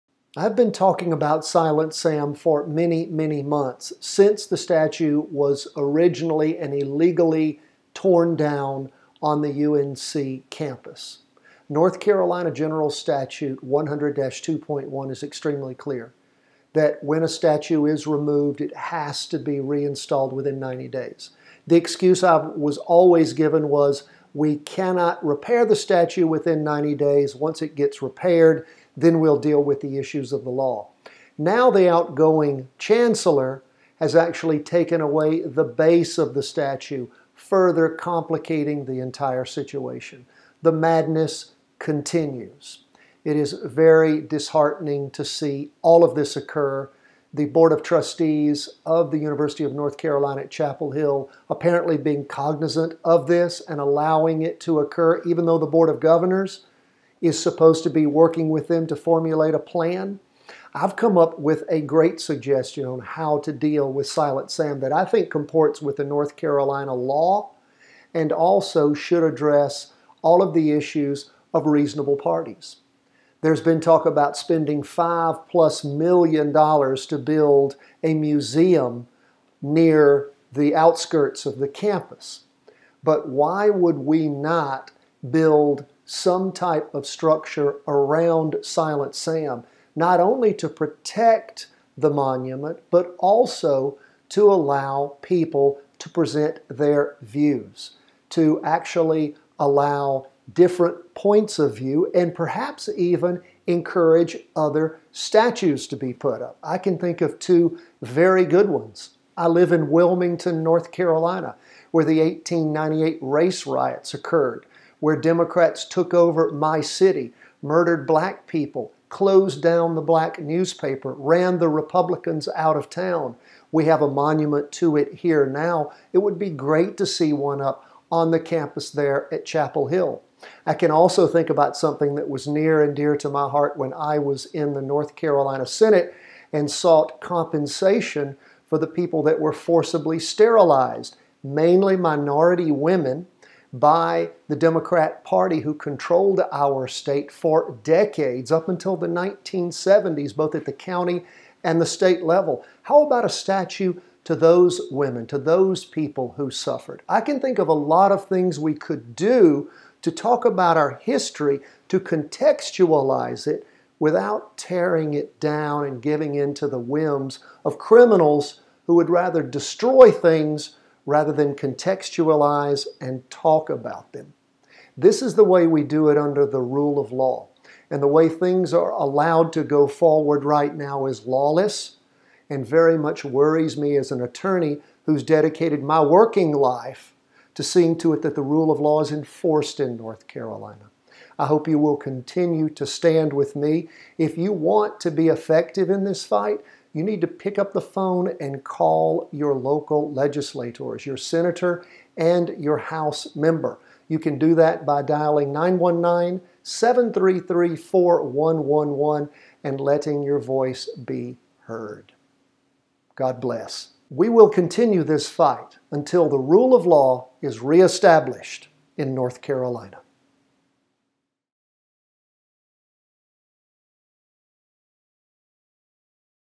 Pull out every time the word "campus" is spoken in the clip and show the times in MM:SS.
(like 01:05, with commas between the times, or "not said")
00:10, 01:21, 02:08.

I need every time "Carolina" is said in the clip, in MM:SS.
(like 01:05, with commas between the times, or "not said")
00:11, 00:49, 01:06, 01:50, 02:15, 03:10, 03:39.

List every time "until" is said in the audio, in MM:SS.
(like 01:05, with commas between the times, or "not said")
02:28, 03:35.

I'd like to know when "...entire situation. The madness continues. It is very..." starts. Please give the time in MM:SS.
00:38.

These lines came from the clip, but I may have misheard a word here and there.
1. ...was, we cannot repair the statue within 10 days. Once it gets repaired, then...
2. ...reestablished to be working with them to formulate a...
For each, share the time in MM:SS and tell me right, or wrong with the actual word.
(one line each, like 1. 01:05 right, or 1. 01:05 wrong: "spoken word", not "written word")
1. 00:23 wrong: "90", not "10"
2. 00:57 wrong: "supposed", not "reestablished".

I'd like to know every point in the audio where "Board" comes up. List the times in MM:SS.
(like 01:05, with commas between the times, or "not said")
00:47, 00:55.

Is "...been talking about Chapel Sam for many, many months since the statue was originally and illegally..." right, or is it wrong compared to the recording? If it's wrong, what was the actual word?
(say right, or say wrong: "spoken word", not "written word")
wrong: "Silent", not "Chapel".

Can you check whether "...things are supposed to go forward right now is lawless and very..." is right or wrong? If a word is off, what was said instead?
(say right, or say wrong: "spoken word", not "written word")
wrong: "allowed", not "supposed".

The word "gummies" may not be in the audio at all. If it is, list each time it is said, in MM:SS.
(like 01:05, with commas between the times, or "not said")
not said.